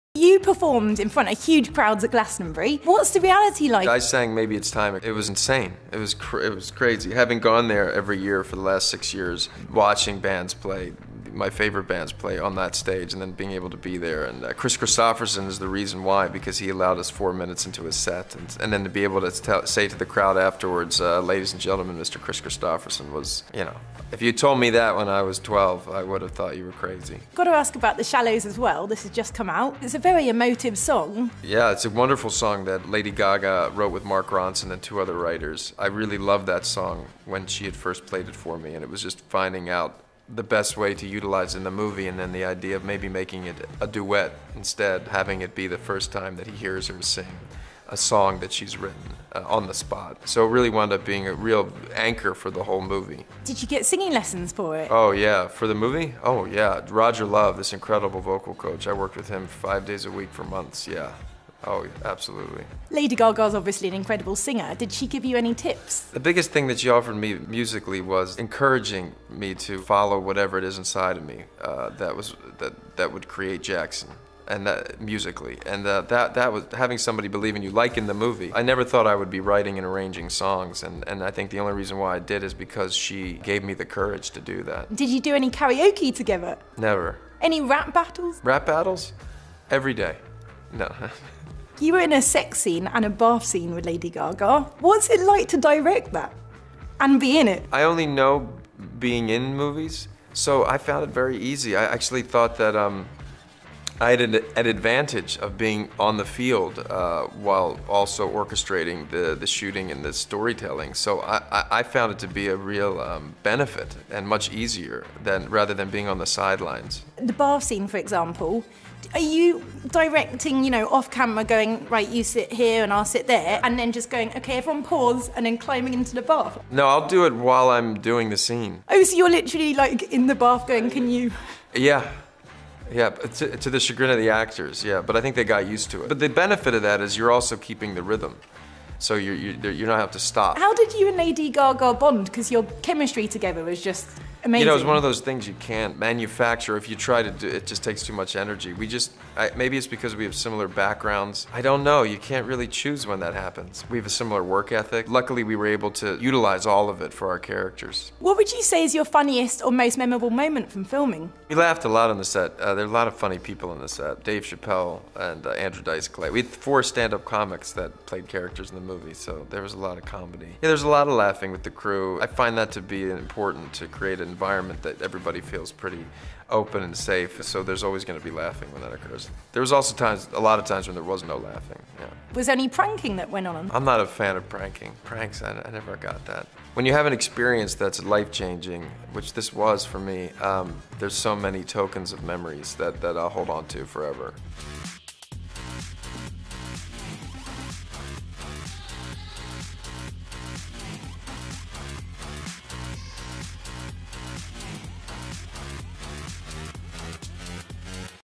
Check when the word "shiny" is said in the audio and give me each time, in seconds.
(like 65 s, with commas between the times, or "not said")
not said.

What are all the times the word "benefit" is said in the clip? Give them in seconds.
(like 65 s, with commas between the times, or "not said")
113 s, 136 s.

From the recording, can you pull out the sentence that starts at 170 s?
Yeah, there's a lot of laughing with the crew.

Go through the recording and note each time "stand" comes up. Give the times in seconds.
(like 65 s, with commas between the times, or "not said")
166 s.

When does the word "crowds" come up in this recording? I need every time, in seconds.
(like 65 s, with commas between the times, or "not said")
1 s, 20 s.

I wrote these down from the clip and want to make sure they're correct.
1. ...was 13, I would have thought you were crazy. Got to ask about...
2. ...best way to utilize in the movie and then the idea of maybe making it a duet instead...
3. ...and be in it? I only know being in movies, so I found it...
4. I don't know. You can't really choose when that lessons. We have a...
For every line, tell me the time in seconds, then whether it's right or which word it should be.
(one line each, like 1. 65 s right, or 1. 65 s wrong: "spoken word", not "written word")
1. 25 s wrong: "12", not "13"
2. 40 s right
3. 96 s right
4. 151 s wrong: "happens", not "lessons".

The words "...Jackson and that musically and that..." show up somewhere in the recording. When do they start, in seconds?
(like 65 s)
73 s.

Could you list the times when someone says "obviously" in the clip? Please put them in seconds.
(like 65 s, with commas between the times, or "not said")
63 s.